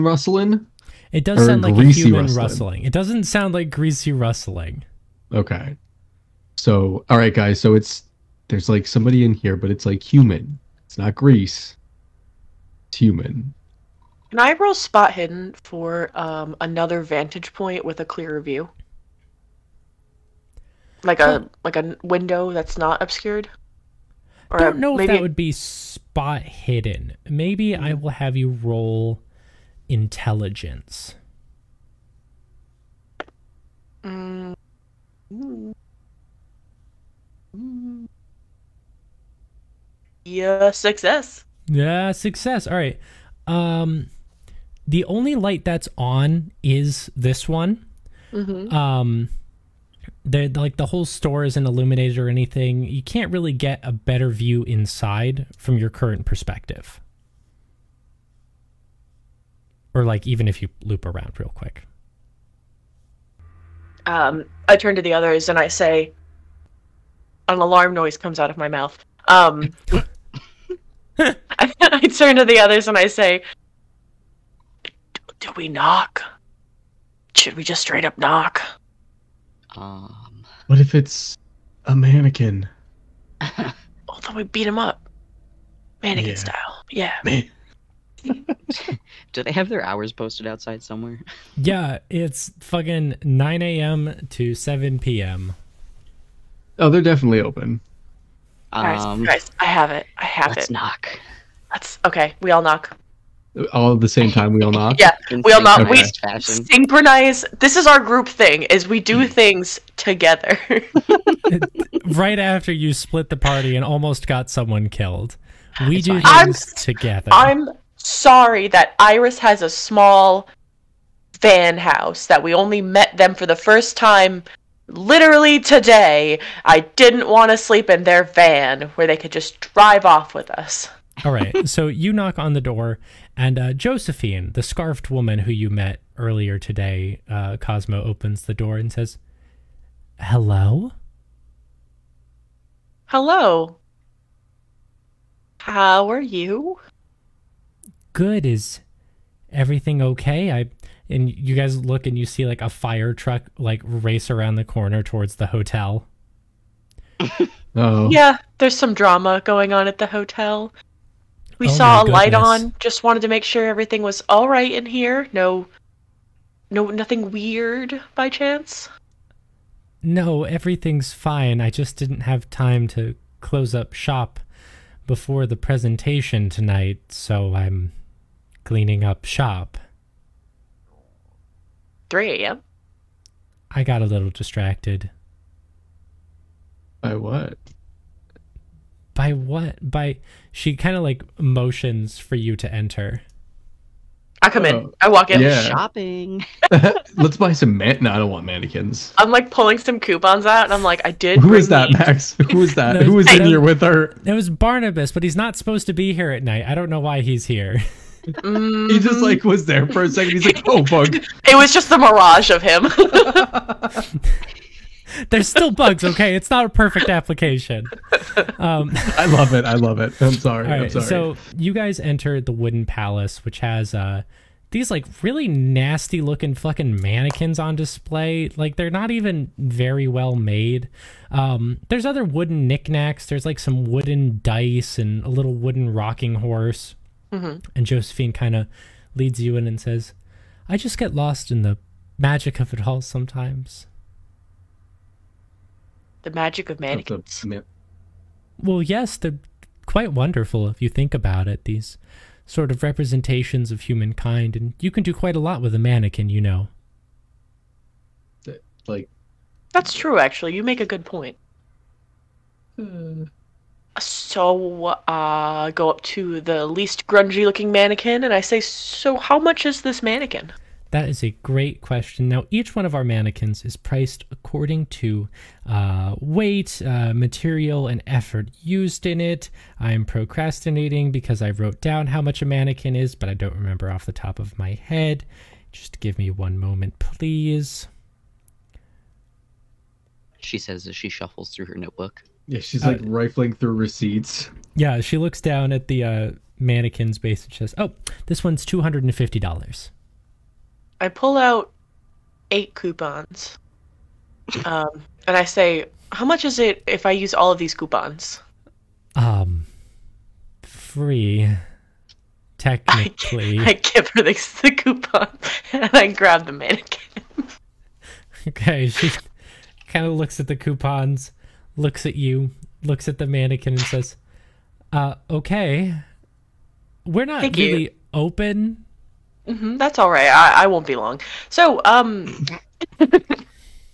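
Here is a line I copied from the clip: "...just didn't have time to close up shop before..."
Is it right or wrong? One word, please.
right.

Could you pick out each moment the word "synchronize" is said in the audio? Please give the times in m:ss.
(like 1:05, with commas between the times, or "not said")
1:46.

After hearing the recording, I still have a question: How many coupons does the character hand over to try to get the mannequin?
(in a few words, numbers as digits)
8.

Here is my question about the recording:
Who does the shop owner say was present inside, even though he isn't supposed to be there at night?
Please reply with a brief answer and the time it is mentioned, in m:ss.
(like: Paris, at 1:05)
Barnabas, at 3:24.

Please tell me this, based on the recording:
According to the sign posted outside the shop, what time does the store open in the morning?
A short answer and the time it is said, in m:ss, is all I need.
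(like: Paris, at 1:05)
9 a.m., at 1:33.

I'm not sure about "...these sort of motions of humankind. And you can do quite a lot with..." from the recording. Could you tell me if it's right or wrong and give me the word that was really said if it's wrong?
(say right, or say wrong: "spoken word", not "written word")
wrong: "representations", not "motions".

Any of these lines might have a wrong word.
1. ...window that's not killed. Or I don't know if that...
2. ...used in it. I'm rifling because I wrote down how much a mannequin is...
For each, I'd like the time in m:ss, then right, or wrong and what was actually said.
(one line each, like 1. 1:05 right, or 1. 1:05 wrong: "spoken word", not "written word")
1. 0:22 wrong: "obscured", not "killed"
2. 4:38 wrong: "procrastinating", not "rifling".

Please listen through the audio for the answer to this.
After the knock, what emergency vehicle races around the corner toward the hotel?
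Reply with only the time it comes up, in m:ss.
2:32.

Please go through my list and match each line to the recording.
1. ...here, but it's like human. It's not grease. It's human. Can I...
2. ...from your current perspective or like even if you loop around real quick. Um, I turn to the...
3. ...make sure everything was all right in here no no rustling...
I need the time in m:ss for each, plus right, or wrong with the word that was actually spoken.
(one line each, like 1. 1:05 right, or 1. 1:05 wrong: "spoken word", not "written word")
1. 0:09 right
2. 0:55 right
3. 2:43 wrong: "nothing", not "rustling".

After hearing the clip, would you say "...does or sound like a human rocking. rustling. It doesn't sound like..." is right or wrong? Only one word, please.
wrong.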